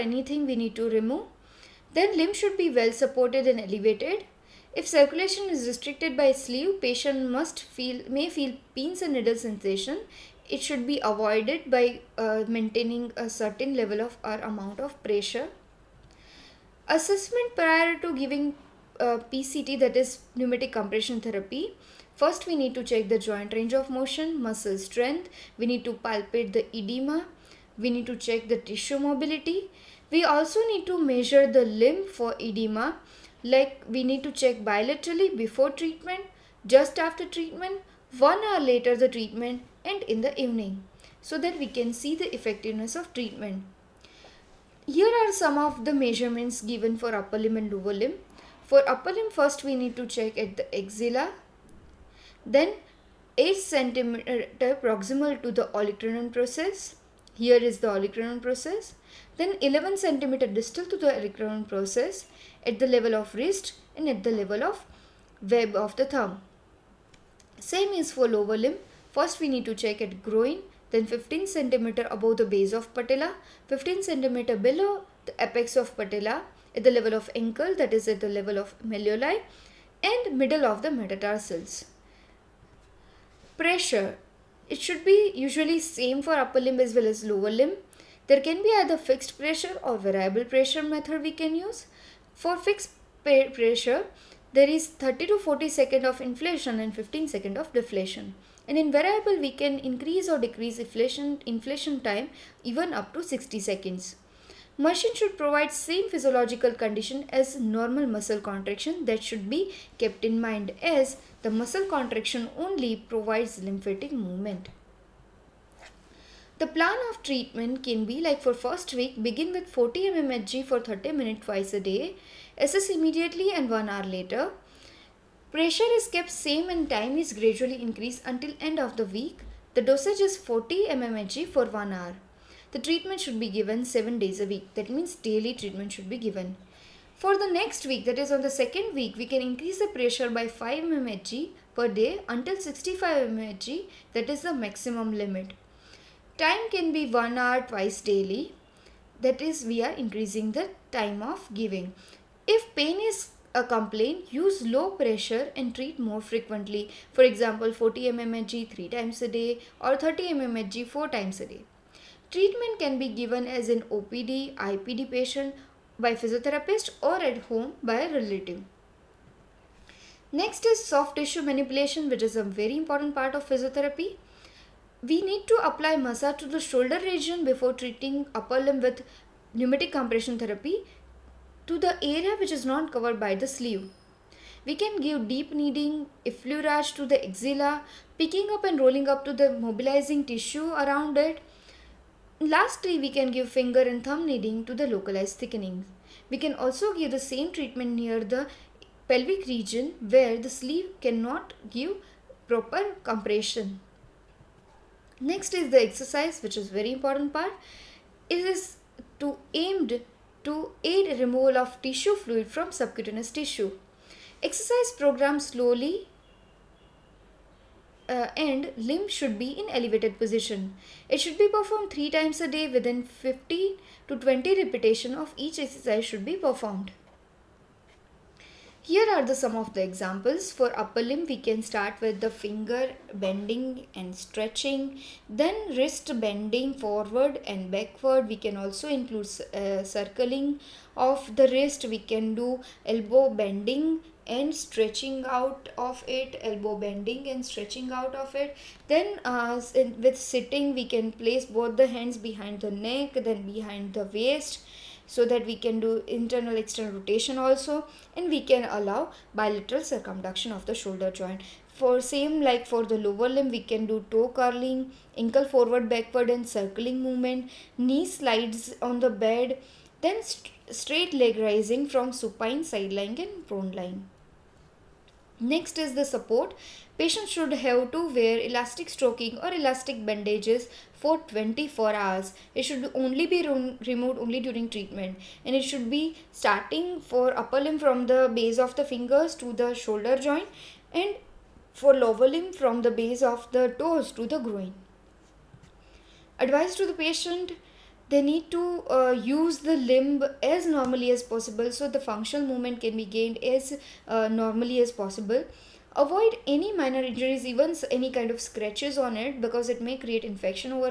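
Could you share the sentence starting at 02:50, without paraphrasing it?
Next is soft tissue manipulation which is a very important part of physiotherapy.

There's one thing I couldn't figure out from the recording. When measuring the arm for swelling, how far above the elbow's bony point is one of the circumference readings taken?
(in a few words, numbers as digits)
8 cm.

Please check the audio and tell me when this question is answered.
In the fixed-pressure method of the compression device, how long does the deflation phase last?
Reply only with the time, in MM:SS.
01:36.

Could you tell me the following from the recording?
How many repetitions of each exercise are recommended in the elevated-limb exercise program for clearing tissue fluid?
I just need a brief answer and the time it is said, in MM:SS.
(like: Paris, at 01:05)
15 to 20, at 03:43.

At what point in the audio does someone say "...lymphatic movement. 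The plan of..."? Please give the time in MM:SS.
01:53.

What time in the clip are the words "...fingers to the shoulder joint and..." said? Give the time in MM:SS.
04:48.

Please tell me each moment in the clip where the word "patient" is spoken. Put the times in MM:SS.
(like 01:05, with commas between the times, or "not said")
00:06, 02:45, 04:36, 04:57.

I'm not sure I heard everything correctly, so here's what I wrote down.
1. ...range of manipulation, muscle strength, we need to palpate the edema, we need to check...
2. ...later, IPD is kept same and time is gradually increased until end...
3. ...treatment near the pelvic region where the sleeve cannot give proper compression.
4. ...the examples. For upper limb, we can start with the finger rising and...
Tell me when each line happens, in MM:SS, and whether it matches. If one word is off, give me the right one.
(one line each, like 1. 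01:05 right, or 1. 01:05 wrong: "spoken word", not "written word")
1. 00:23 wrong: "motion", not "manipulation"
2. 02:04 wrong: "Pressure", not "IPD"
3. 03:17 right
4. 03:49 wrong: "bending", not "rising".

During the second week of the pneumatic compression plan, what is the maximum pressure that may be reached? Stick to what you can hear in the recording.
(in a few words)
65 mmHg.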